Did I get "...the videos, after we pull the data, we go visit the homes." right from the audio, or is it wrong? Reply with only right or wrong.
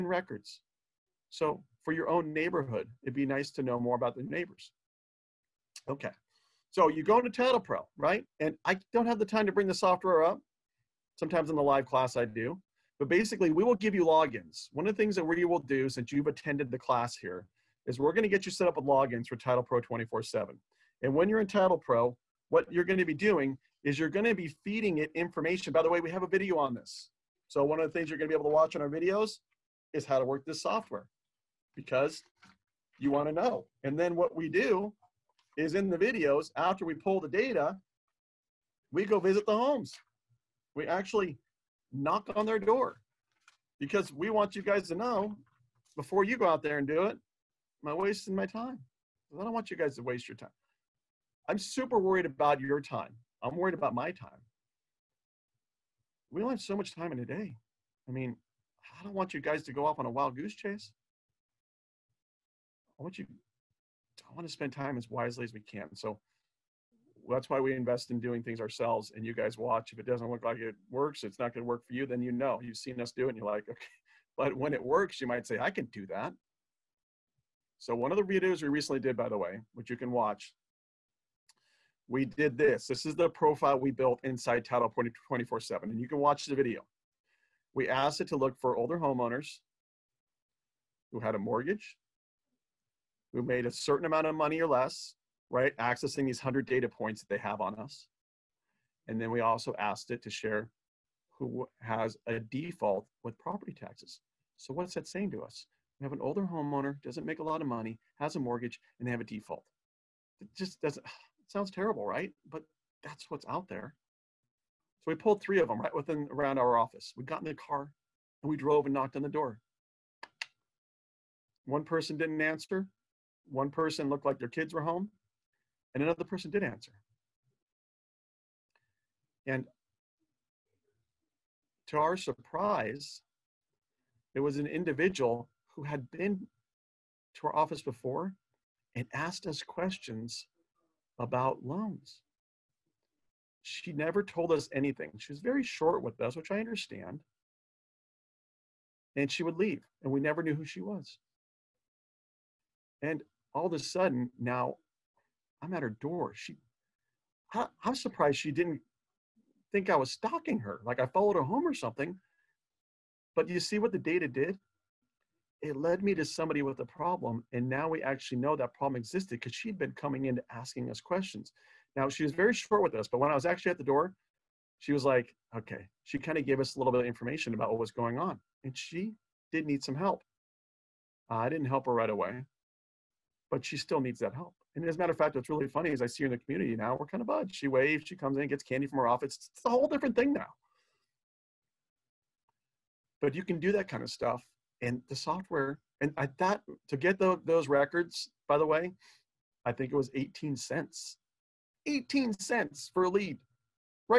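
right.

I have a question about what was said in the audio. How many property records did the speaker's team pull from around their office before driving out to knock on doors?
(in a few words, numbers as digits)
3.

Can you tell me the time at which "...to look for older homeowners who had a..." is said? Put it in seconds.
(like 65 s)
88 s.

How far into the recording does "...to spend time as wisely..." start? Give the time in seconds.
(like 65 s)
64 s.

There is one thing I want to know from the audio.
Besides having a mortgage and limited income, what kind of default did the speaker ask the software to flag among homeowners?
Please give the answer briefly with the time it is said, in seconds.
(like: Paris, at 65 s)
property taxes, at 103 s.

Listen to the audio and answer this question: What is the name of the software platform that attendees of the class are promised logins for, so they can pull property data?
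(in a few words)
Title Pro 24 seven.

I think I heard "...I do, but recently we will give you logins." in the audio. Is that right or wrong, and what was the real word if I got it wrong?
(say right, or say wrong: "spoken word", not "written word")
wrong: "basically", not "recently".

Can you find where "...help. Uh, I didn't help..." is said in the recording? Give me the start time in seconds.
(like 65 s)
179 s.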